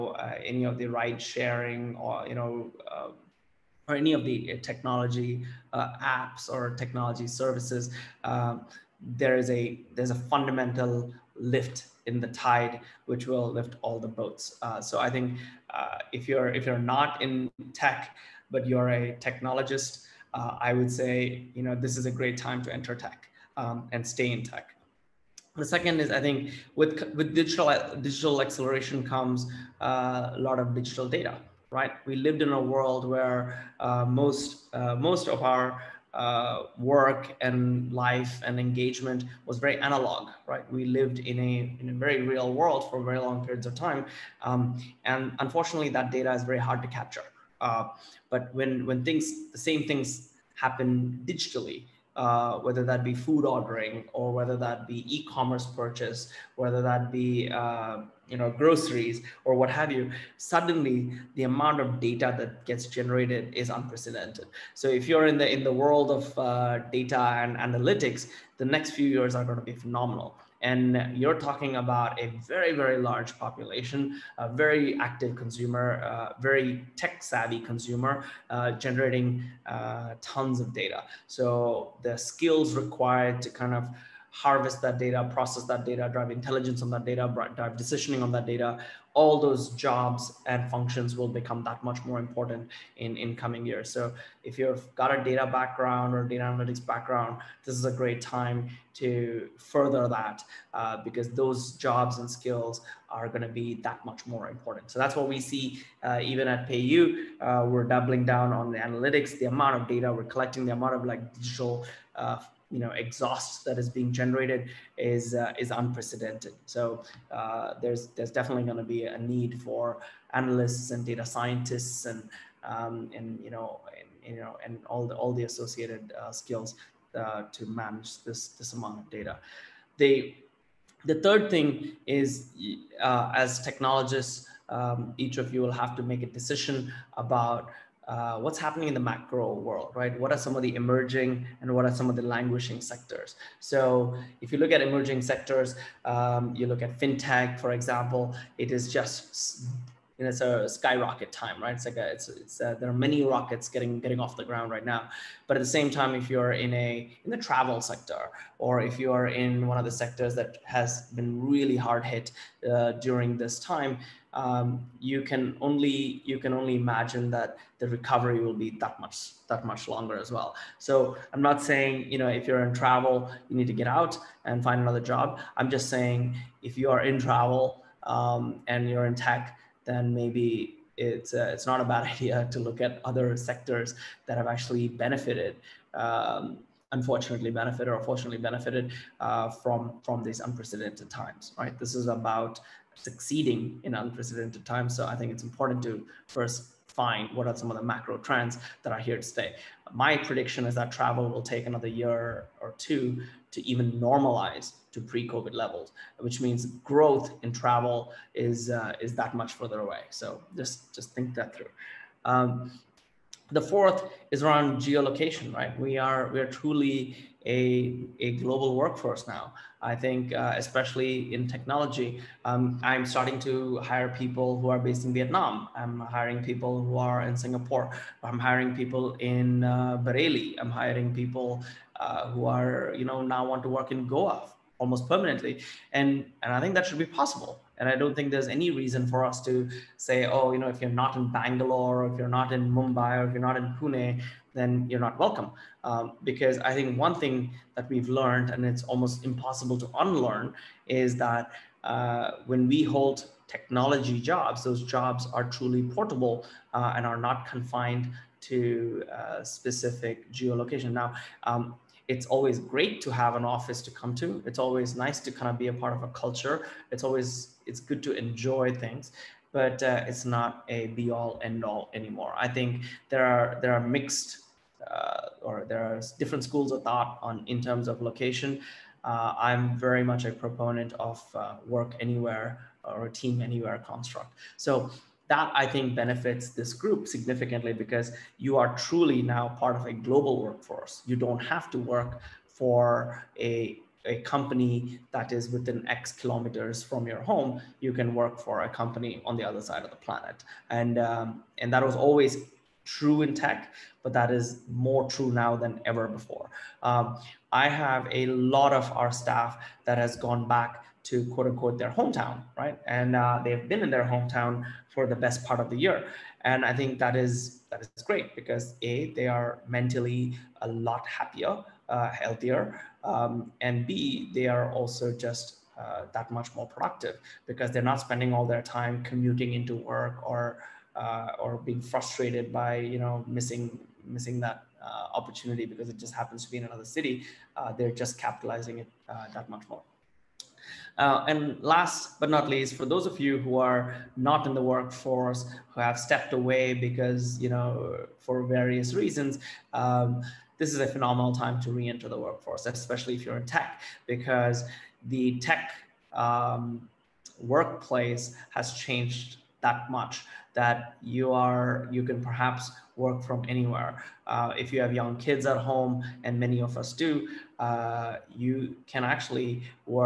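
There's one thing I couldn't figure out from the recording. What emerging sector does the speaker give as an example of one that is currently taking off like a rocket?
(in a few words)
fintech.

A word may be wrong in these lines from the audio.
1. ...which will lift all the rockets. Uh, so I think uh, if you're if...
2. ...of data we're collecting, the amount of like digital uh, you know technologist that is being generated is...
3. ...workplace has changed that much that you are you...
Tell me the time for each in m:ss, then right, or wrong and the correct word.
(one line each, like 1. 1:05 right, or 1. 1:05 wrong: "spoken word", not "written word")
1. 0:13 wrong: "boats", not "rockets"
2. 1:49 wrong: "exhaust", not "technologist"
3. 5:57 right.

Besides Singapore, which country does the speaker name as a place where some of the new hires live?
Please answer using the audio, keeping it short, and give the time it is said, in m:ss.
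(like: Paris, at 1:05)
Vietnam, at 3:45.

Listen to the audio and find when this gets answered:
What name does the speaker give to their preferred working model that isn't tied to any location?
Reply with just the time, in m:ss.
4:41.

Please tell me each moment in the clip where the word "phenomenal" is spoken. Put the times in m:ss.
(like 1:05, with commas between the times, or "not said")
1:09, 5:50.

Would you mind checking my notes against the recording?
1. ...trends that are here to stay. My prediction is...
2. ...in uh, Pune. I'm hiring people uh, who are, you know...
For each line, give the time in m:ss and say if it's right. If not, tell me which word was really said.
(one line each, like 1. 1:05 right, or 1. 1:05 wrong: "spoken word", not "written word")
1. 3:18 right
2. 3:49 wrong: "Bareilly", not "Pune".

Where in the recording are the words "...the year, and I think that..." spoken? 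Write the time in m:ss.
5:15.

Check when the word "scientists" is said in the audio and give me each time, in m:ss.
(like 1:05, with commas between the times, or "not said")
2:01.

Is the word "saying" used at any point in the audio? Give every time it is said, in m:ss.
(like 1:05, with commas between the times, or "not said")
2:51, 2:55.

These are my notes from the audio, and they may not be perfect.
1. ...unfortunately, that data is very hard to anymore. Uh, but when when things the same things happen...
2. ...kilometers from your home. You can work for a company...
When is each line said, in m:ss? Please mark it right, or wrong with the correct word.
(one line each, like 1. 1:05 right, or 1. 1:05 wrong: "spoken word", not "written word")
1. 0:45 wrong: "capture", not "anymore"
2. 4:56 right.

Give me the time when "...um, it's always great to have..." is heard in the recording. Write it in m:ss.
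4:21.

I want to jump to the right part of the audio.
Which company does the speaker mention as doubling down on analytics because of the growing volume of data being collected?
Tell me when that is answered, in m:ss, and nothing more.
1:46.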